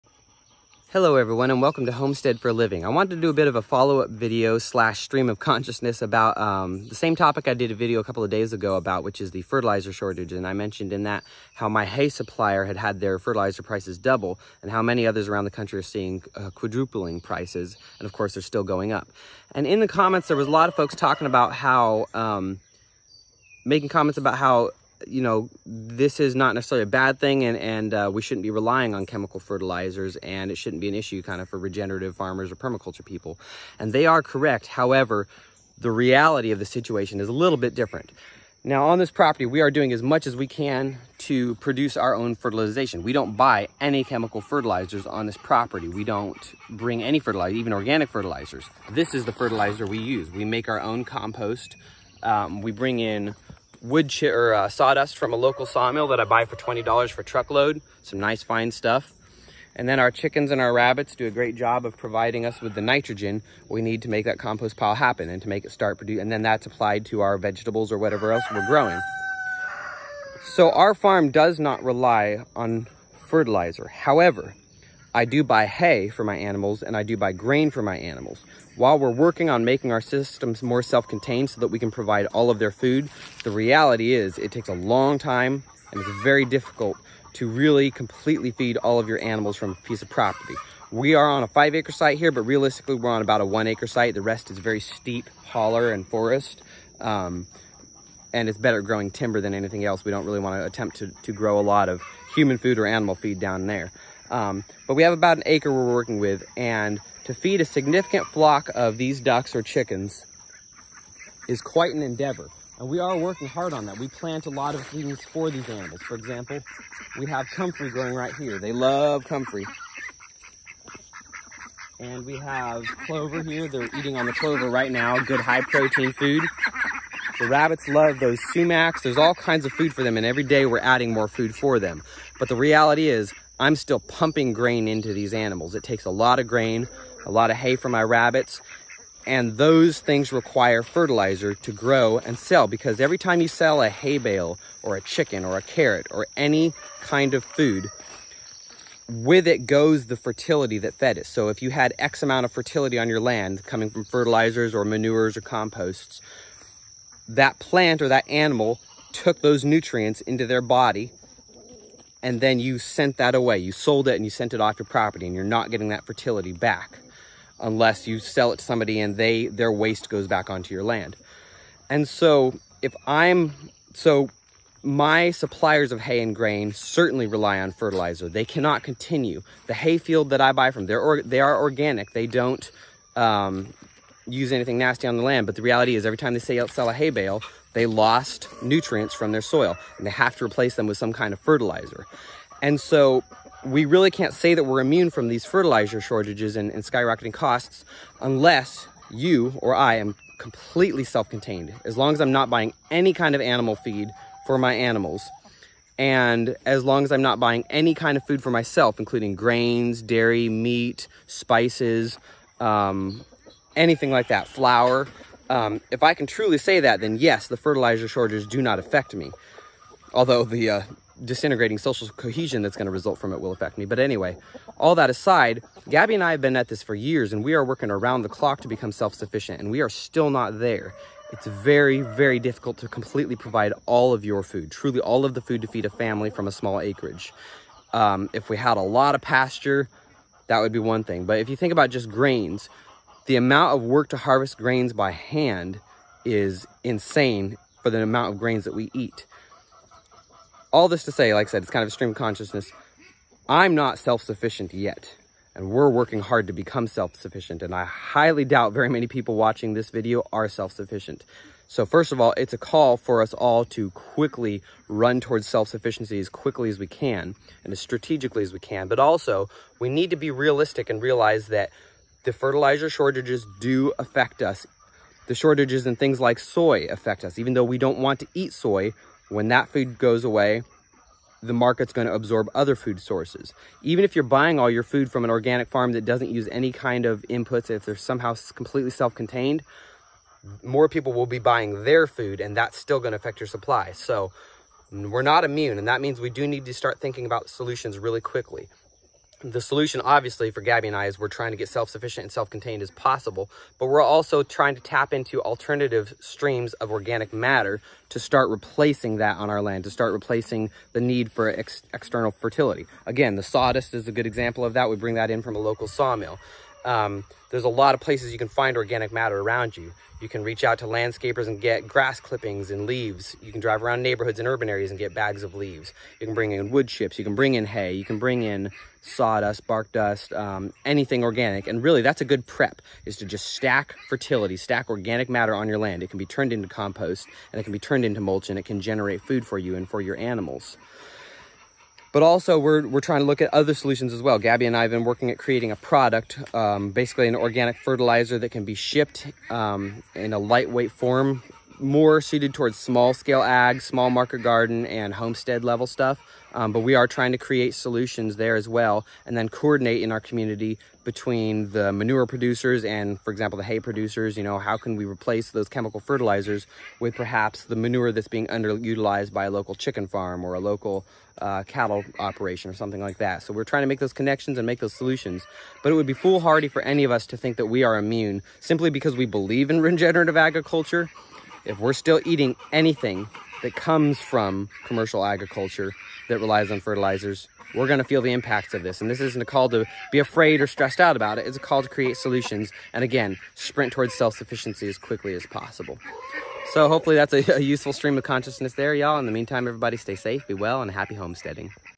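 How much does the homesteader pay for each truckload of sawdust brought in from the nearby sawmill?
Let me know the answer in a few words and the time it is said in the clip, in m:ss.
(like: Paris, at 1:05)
$20, at 0:56.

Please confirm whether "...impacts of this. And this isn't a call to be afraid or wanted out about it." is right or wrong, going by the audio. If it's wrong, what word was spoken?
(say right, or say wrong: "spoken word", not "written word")
wrong: "stressed", not "wanted".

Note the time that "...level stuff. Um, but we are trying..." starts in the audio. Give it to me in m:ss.
5:55.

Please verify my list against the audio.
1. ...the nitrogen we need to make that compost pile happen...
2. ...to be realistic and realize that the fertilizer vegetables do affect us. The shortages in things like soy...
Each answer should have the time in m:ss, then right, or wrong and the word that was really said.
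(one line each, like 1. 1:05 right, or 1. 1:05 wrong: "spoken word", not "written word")
1. 1:02 right
2. 4:30 wrong: "shortages", not "vegetables".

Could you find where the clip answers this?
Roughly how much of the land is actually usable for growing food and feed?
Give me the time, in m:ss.
1:45.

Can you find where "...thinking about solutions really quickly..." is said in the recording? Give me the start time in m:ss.
4:56.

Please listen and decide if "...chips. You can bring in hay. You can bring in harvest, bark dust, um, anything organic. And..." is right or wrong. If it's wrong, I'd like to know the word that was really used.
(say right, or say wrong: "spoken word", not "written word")
wrong: "sawdust", not "harvest".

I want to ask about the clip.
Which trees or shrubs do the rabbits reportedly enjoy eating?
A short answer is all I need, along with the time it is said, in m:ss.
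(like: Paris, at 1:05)
sumacs, at 2:08.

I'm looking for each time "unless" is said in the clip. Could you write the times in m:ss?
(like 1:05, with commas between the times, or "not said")
2:47, 3:18.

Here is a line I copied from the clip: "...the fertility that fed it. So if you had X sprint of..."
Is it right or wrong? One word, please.
wrong.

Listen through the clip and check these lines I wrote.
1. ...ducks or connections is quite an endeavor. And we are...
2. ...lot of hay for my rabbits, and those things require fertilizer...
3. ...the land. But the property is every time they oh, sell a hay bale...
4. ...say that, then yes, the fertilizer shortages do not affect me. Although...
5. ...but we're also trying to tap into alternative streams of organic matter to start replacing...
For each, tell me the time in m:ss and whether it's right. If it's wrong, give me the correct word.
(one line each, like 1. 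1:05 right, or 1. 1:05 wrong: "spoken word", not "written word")
1. 1:49 wrong: "chickens", not "connections"
2. 2:17 right
3. 3:05 wrong: "reality", not "property"
4. 3:36 right
5. 5:03 right.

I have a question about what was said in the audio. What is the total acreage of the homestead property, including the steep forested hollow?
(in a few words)
5 acres.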